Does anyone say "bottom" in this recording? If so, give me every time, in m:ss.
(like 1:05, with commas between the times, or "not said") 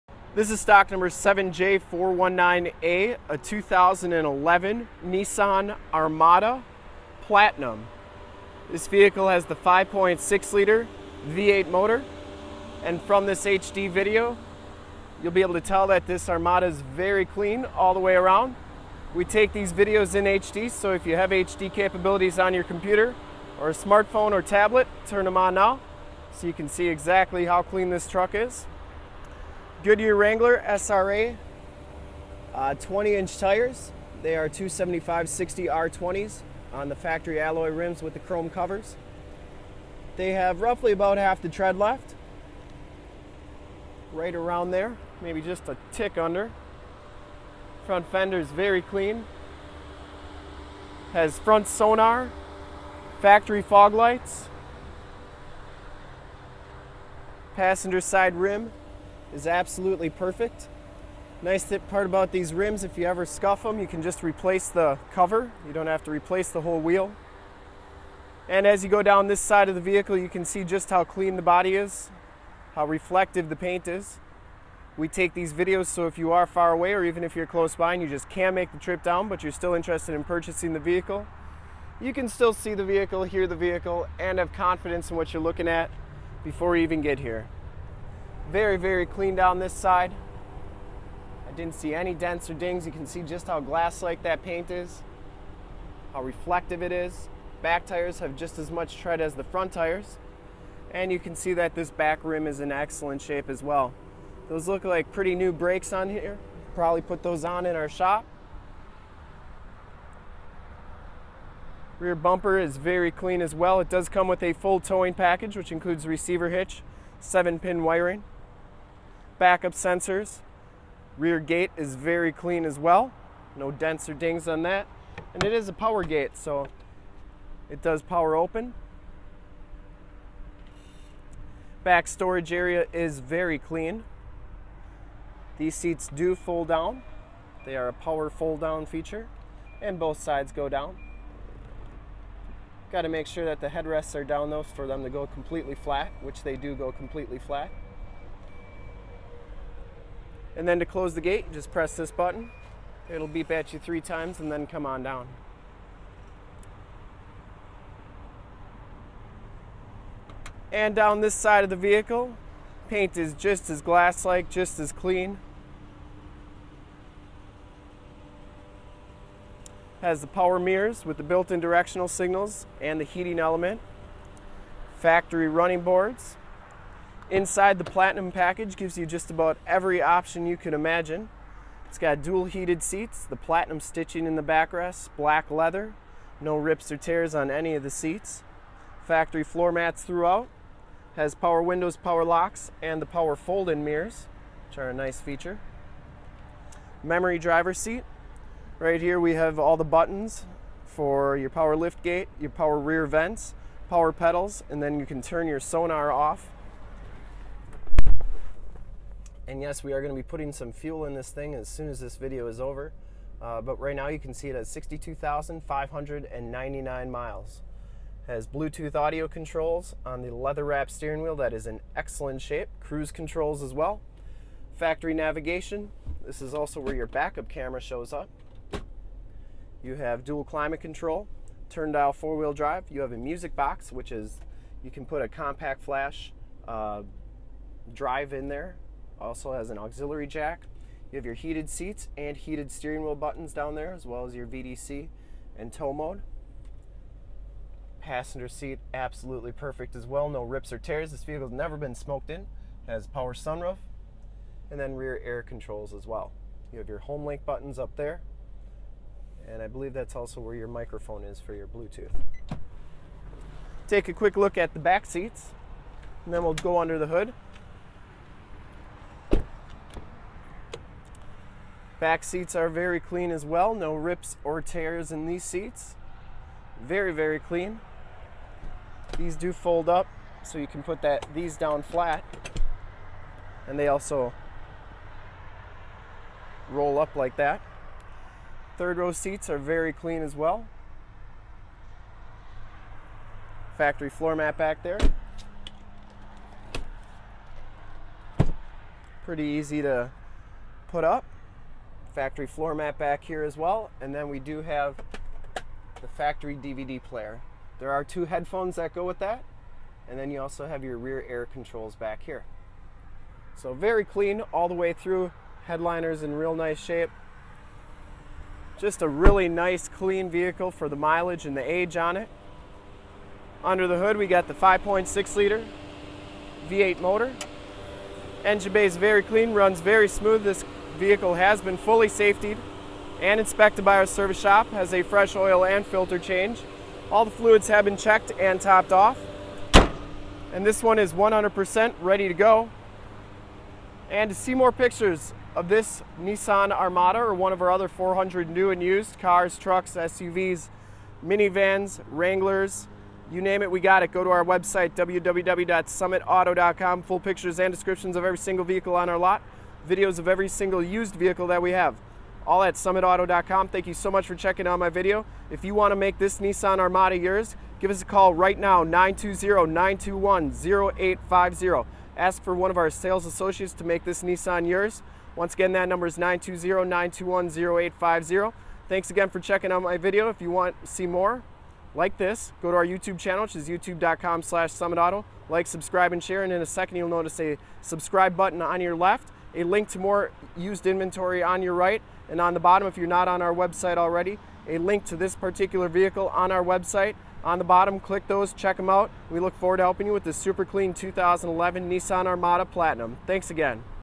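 6:32, 6:37.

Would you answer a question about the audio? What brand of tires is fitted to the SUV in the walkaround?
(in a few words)
Goodyear Wrangler.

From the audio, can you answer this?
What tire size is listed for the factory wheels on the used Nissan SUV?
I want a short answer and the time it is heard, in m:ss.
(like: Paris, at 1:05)
275-60R20, at 0:34.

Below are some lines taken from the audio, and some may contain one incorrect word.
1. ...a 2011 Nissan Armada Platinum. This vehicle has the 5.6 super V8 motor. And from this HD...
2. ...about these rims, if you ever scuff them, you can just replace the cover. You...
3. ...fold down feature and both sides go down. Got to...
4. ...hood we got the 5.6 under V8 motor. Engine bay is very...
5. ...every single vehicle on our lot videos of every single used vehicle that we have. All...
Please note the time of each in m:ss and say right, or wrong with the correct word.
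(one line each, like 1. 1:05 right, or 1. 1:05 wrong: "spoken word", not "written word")
1. 0:03 wrong: "liter", not "super"
2. 1:02 right
3. 2:18 right
4. 5:23 wrong: "liter", not "under"
5. 5:58 right.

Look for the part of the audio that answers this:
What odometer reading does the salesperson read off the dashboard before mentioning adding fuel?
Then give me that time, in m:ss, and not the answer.
3:34.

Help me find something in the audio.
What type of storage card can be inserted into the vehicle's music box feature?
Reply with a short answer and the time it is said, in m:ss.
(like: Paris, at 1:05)
compact flash, at 3:55.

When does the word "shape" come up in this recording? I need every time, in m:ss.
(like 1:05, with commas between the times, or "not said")
1:43, 3:42, 5:16.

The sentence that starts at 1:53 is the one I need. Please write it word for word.
It does come with a full towing package, which includes receiver hitch, seven pin wiring, backup sensors.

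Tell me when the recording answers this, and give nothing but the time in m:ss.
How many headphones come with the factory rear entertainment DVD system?
5:08.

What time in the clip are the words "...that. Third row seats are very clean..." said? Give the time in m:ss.
4:47.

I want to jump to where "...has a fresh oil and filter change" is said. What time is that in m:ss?
5:34.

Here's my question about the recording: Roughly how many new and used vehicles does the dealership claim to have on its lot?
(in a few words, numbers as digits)
400.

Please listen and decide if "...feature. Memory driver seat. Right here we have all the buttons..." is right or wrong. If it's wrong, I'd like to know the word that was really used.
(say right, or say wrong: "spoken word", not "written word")
right.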